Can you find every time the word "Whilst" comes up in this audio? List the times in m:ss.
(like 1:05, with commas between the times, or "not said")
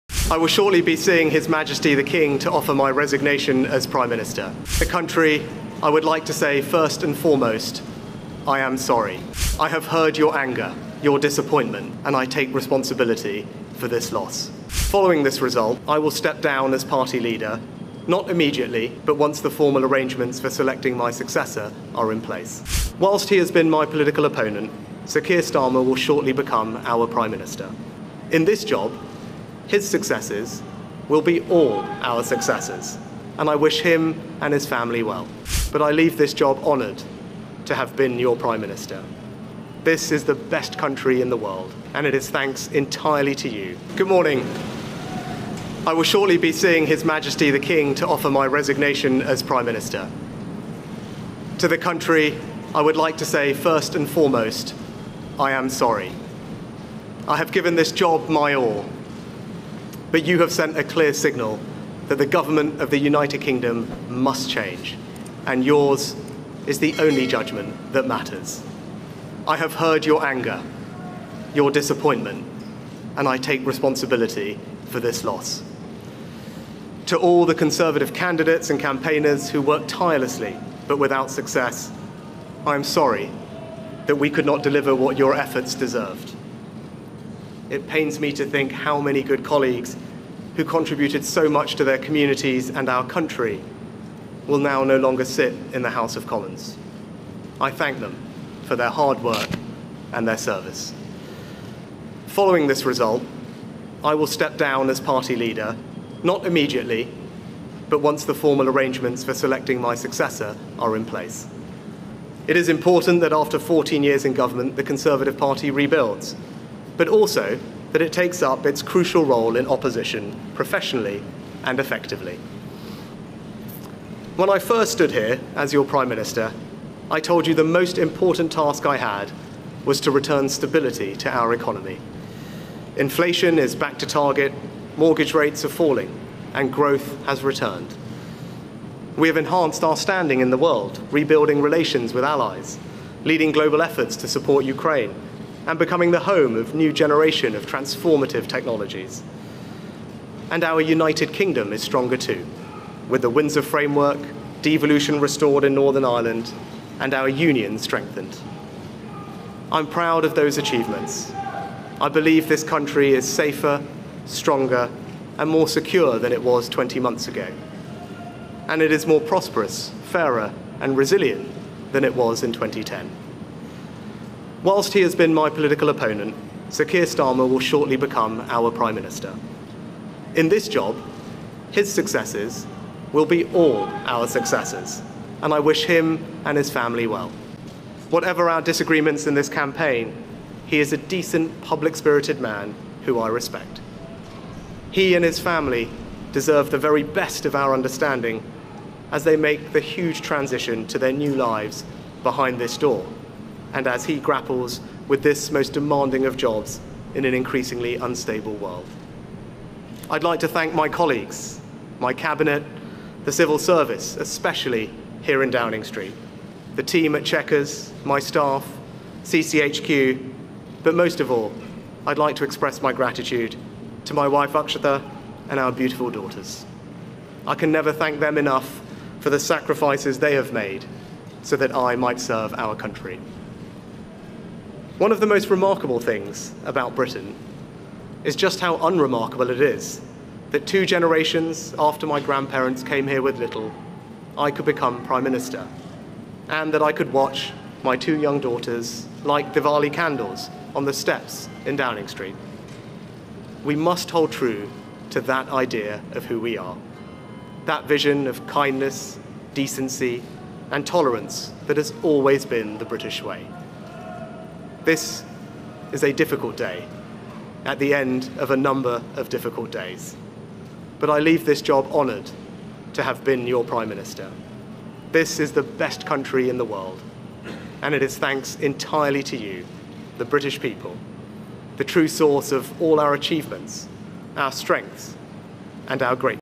0:22, 2:54.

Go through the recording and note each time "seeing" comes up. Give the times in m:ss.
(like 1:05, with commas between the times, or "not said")
0:00, 0:46.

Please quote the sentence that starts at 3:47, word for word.
I can never thank them enough for the sacrifices they have made so that I might serve our country.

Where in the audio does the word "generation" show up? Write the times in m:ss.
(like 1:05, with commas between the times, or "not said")
2:26, 4:00.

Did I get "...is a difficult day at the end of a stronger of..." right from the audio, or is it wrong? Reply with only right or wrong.
wrong.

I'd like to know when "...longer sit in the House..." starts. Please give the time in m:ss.
1:34.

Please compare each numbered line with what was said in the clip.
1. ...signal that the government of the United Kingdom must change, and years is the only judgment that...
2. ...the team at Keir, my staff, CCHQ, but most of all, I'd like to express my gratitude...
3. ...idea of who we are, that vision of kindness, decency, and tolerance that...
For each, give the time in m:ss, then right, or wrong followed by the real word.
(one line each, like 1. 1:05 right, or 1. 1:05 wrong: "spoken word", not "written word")
1. 1:01 wrong: "yours", not "years"
2. 3:36 wrong: "Chequers", not "Keir"
3. 4:15 right.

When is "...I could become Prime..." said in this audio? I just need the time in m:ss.
4:04.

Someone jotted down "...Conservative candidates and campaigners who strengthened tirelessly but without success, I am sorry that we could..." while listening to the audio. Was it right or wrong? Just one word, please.
wrong.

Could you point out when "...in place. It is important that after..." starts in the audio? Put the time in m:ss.
1:50.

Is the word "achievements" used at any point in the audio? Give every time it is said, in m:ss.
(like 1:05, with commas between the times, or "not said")
2:40, 4:43.